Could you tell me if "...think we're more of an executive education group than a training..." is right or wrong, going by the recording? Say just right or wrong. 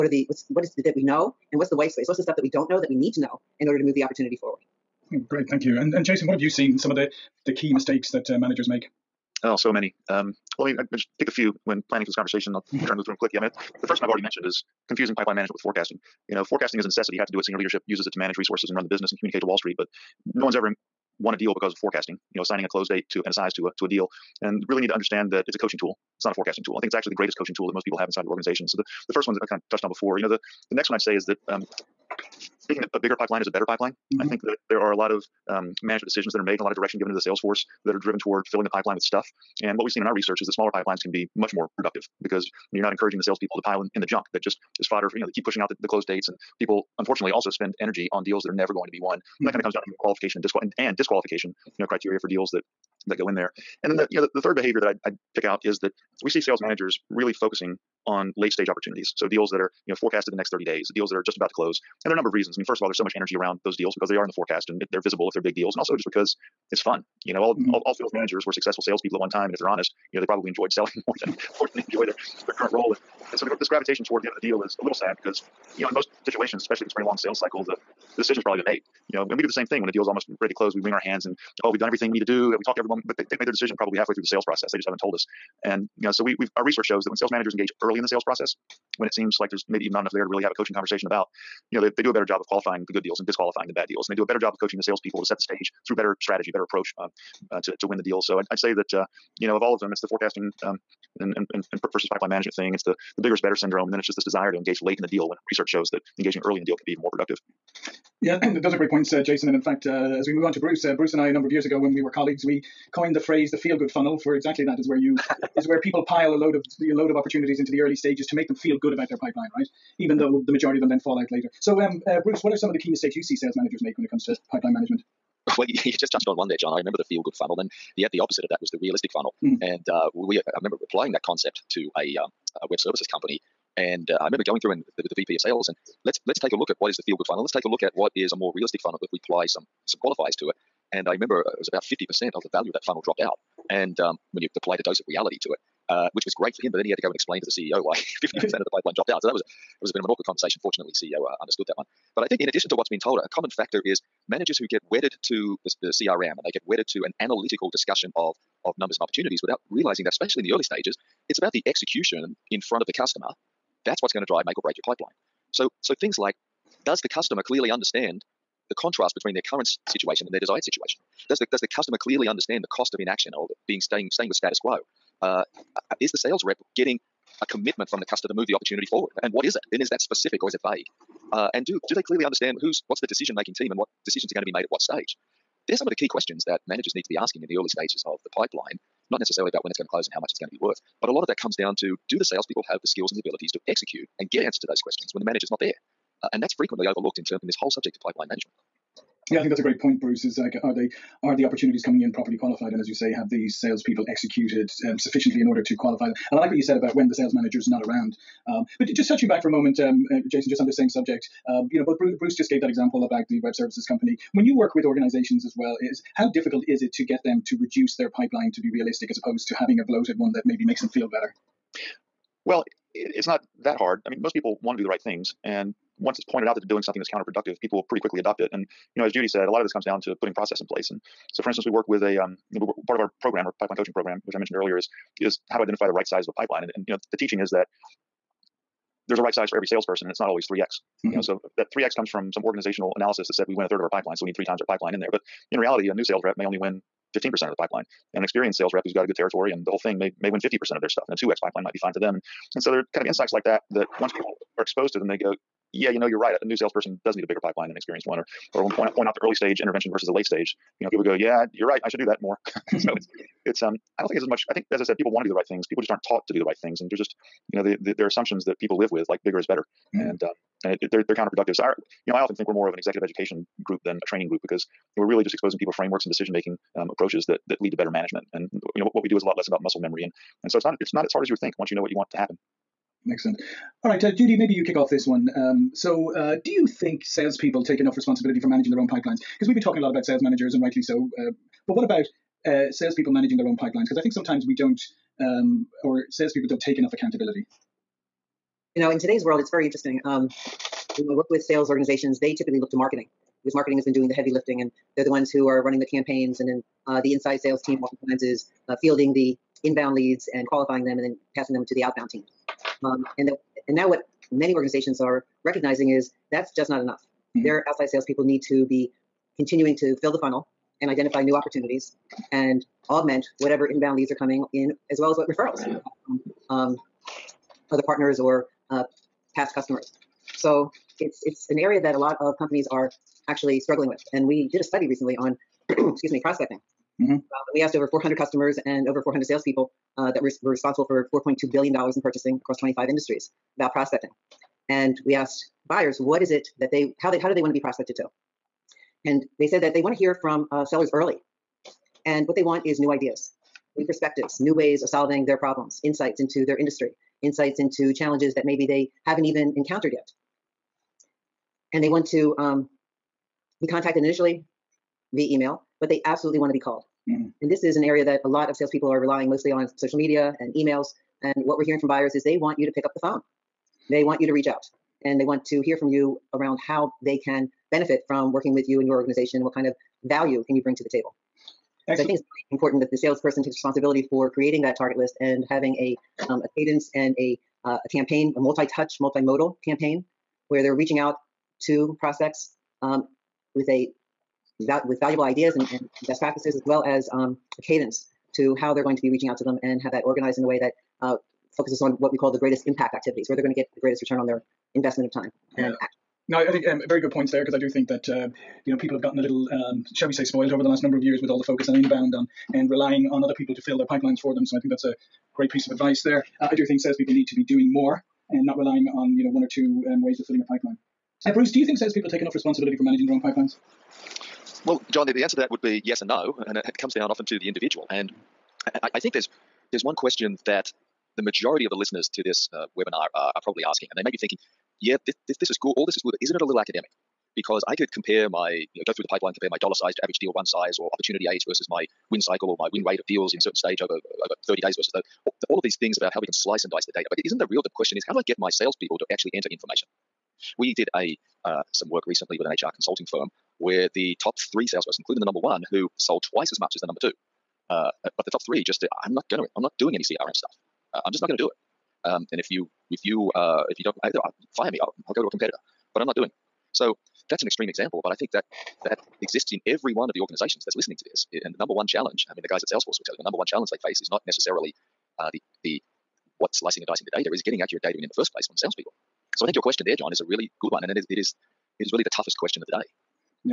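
right.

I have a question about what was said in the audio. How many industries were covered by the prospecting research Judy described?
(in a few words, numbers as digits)
25.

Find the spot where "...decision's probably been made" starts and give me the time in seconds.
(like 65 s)
78 s.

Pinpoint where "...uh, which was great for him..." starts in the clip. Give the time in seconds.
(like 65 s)
145 s.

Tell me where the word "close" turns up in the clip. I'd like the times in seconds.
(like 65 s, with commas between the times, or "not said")
22 s, 45 s, 61 s, 80 s, 189 s.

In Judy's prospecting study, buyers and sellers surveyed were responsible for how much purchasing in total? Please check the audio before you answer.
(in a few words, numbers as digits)
4.2 billion dollars.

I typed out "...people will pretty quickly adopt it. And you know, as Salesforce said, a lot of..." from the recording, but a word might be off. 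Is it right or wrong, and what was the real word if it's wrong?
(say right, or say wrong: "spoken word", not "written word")
wrong: "Judy", not "Salesforce".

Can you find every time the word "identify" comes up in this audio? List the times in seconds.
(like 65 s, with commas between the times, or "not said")
235 s, 320 s.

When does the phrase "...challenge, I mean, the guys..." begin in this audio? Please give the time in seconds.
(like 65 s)
471 s.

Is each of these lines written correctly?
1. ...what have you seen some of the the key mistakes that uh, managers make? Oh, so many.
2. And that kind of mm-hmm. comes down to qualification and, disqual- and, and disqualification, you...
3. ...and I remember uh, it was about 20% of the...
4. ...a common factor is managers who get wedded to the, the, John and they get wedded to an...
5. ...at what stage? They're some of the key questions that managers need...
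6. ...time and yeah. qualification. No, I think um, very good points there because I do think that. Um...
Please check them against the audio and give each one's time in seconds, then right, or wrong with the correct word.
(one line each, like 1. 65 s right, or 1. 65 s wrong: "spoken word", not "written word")
1. 6 s right
2. 49 s right
3. 140 s wrong: "50", not "20"
4. 153 s wrong: "CRM", not "John"
5. 184 s right
6. 405 s wrong: "action", not "qualification".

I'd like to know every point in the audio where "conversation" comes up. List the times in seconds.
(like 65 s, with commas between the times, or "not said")
12 s, 90 s, 150 s.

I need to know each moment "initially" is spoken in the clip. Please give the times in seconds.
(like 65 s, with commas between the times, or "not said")
364 s.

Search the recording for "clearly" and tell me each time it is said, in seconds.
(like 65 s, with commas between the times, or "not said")
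167 s, 171 s, 182 s.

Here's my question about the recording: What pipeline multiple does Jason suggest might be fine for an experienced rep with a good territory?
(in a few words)
2x.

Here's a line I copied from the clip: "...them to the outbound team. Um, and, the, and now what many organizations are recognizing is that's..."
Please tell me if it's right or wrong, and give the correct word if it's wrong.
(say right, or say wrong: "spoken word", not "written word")
right.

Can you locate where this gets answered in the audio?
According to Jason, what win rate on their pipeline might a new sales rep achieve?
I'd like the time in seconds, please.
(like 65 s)
247 s.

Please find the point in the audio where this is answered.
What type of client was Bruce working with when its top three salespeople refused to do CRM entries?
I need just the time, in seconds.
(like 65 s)
452 s.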